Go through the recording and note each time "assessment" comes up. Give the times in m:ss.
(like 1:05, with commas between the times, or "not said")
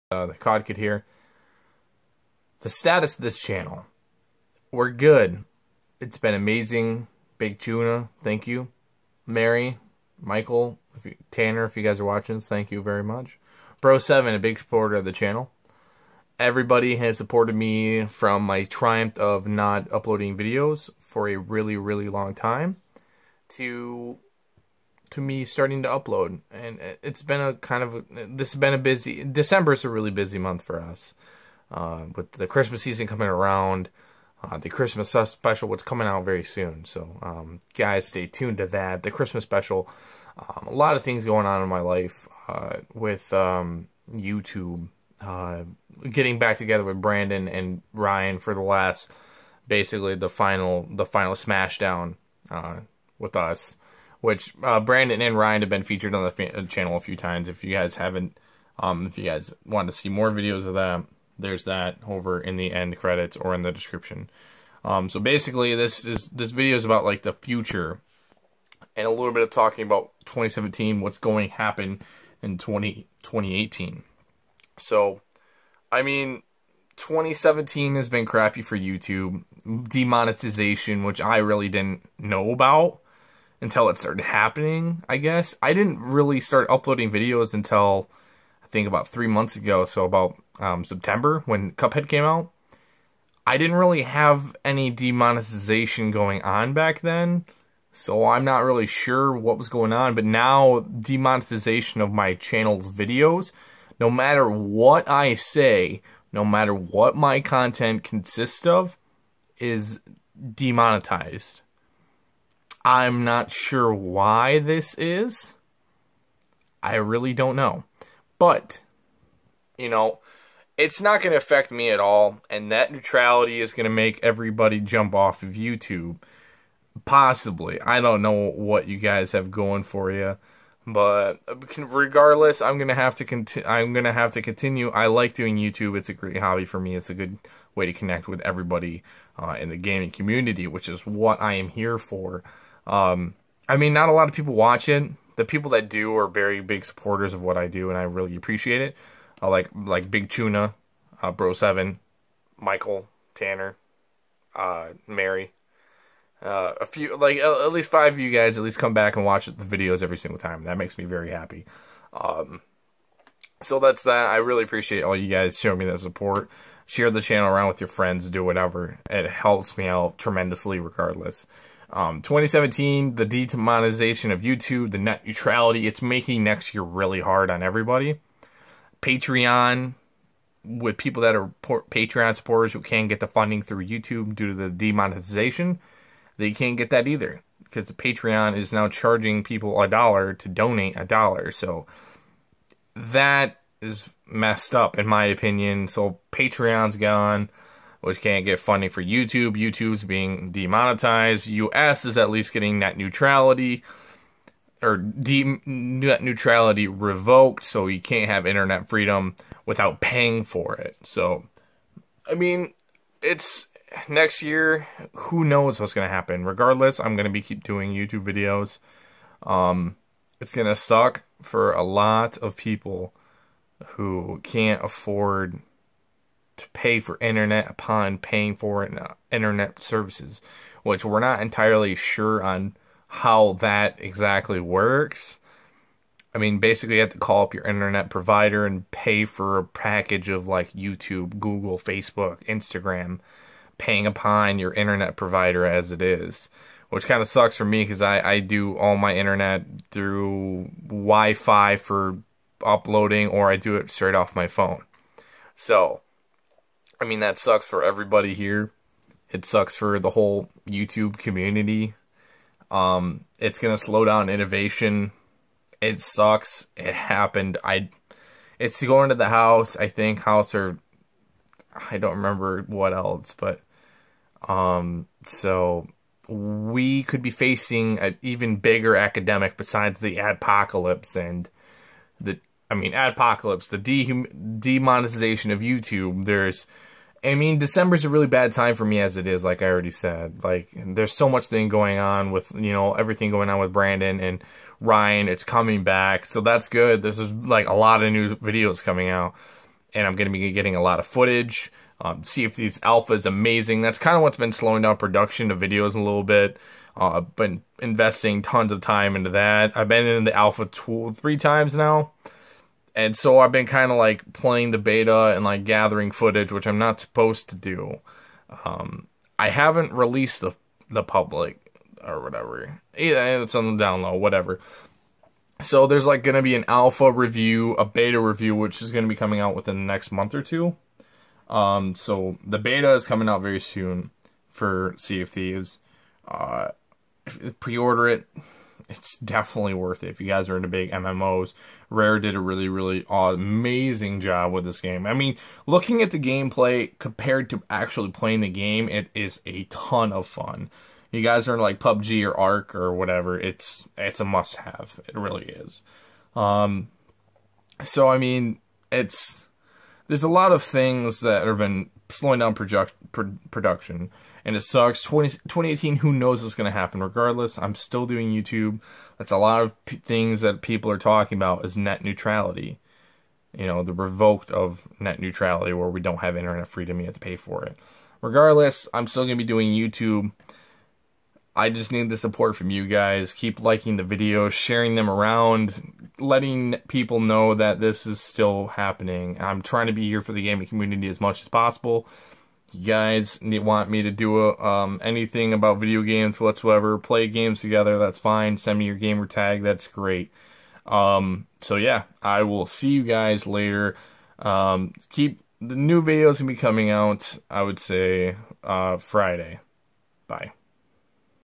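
not said.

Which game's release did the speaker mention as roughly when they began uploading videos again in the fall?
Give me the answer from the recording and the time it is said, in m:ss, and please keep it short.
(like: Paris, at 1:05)
Cuphead, at 1:31.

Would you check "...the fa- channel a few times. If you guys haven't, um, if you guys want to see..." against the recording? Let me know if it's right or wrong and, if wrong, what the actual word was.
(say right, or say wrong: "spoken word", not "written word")
right.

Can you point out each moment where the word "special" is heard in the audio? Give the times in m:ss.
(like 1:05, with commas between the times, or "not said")
0:35, 0:39.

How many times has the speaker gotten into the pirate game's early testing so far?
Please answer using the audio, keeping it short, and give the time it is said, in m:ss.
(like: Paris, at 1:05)
3 times, at 5:11.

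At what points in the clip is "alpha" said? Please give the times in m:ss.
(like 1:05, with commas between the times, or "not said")
5:02, 5:10, 5:26.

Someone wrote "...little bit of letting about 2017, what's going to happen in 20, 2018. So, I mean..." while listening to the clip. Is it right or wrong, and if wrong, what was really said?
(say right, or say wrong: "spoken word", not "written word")
wrong: "talking", not "letting".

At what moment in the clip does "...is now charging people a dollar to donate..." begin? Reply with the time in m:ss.
3:08.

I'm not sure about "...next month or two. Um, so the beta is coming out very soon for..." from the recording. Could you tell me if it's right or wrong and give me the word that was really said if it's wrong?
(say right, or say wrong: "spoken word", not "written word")
right.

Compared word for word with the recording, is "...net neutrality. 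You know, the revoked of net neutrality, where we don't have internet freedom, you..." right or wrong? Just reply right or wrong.
right.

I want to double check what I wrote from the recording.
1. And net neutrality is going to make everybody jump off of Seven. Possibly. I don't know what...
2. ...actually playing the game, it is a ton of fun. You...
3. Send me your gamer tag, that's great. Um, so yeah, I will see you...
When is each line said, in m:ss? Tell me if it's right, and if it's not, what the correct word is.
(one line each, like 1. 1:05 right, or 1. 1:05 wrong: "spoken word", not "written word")
1. 2:02 wrong: "YouTube", not "Seven"
2. 5:47 right
3. 6:38 right.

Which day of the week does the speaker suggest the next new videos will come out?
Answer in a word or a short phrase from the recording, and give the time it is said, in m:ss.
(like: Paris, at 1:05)
Friday, at 6:48.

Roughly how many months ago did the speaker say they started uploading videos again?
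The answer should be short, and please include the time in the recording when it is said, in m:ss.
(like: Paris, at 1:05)
3 months, at 1:29.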